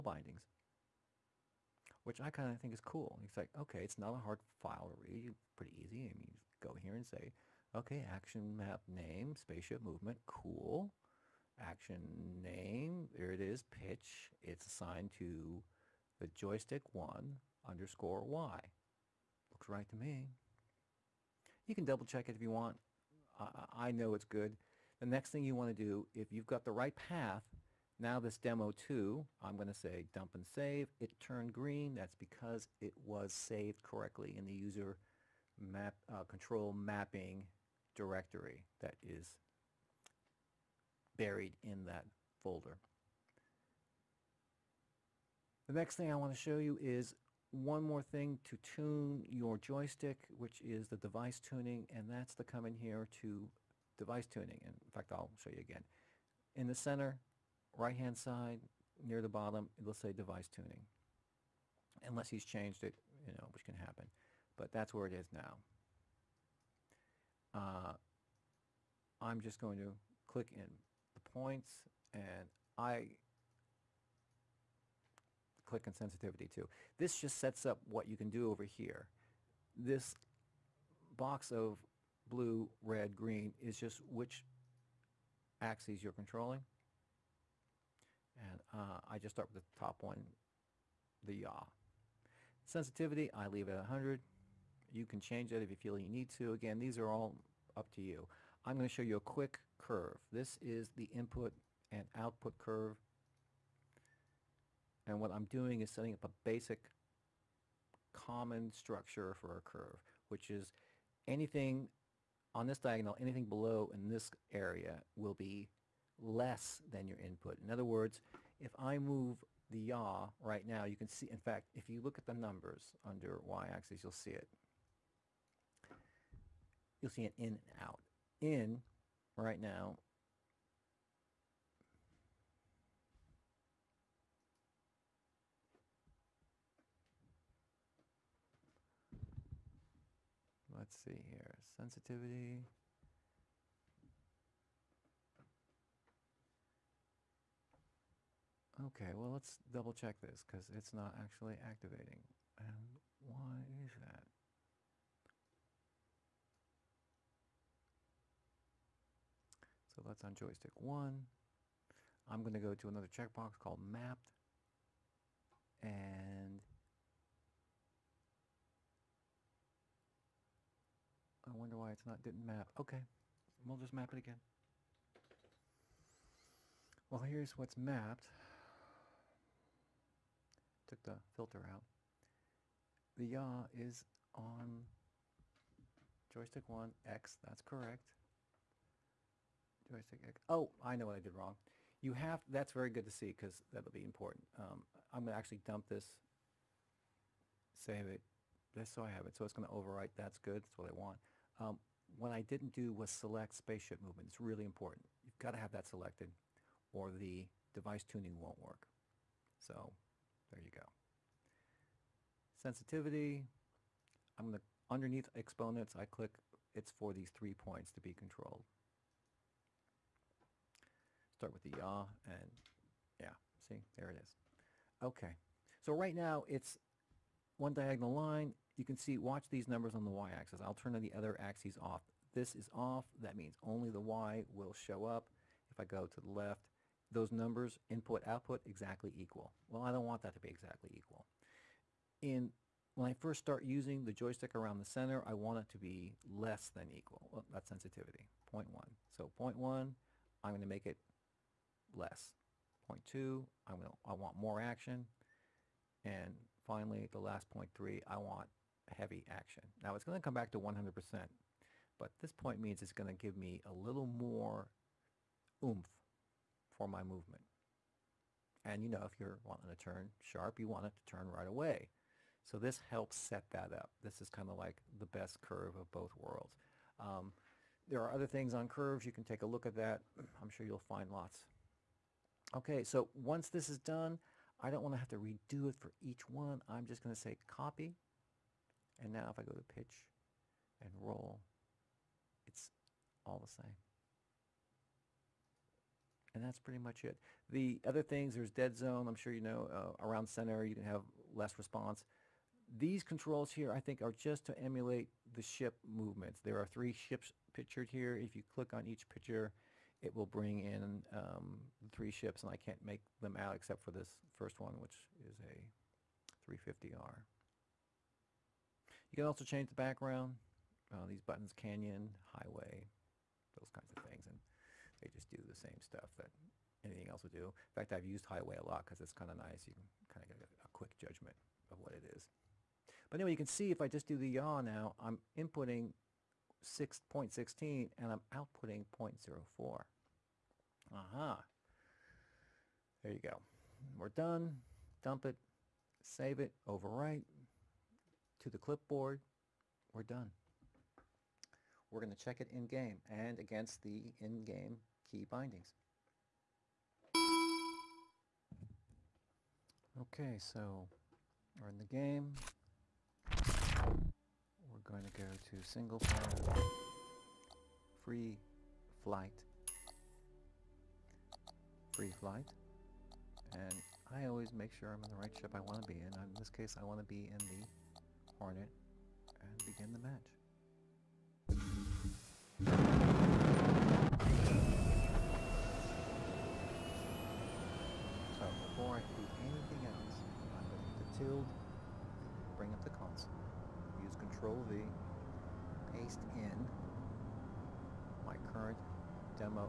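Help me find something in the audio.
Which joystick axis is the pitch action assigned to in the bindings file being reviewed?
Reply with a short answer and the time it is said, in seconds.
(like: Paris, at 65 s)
joystick 1_Y, at 16 s.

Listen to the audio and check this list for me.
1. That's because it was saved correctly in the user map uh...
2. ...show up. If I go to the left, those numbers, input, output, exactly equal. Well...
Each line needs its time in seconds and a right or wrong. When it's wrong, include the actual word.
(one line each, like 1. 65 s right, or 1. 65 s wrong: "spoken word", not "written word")
1. 31 s right
2. 234 s right.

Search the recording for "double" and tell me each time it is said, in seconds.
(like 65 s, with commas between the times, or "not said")
21 s, 149 s.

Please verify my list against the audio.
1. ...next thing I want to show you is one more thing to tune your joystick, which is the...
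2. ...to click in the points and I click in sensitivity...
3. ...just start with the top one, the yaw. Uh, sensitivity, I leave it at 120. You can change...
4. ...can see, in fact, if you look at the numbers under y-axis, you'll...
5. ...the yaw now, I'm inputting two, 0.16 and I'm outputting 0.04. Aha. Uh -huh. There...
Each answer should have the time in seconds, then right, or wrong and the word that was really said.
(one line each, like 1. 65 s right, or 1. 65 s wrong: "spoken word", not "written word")
1. 45 s right
2. 69 s right
3. 89 s wrong: "100", not "120"
4. 120 s right
5. 334 s wrong: "six", not "two".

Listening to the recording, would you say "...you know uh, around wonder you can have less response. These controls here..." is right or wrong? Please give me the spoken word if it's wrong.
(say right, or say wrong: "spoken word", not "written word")
wrong: "center", not "wonder".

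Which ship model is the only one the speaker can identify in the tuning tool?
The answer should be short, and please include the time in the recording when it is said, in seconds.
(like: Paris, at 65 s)
350R, at 316 s.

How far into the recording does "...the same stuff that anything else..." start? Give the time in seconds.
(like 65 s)
325 s.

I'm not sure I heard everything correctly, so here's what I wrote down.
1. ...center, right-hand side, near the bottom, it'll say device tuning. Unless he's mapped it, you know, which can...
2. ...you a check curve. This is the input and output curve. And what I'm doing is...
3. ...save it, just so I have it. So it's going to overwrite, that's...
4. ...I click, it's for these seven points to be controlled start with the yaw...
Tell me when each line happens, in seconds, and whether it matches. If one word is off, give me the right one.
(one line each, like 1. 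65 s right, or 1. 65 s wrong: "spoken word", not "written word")
1. 56 s wrong: "changed", not "mapped"
2. 99 s wrong: "quick", not "check"
3. 197 s right
4. 215 s wrong: "three", not "seven".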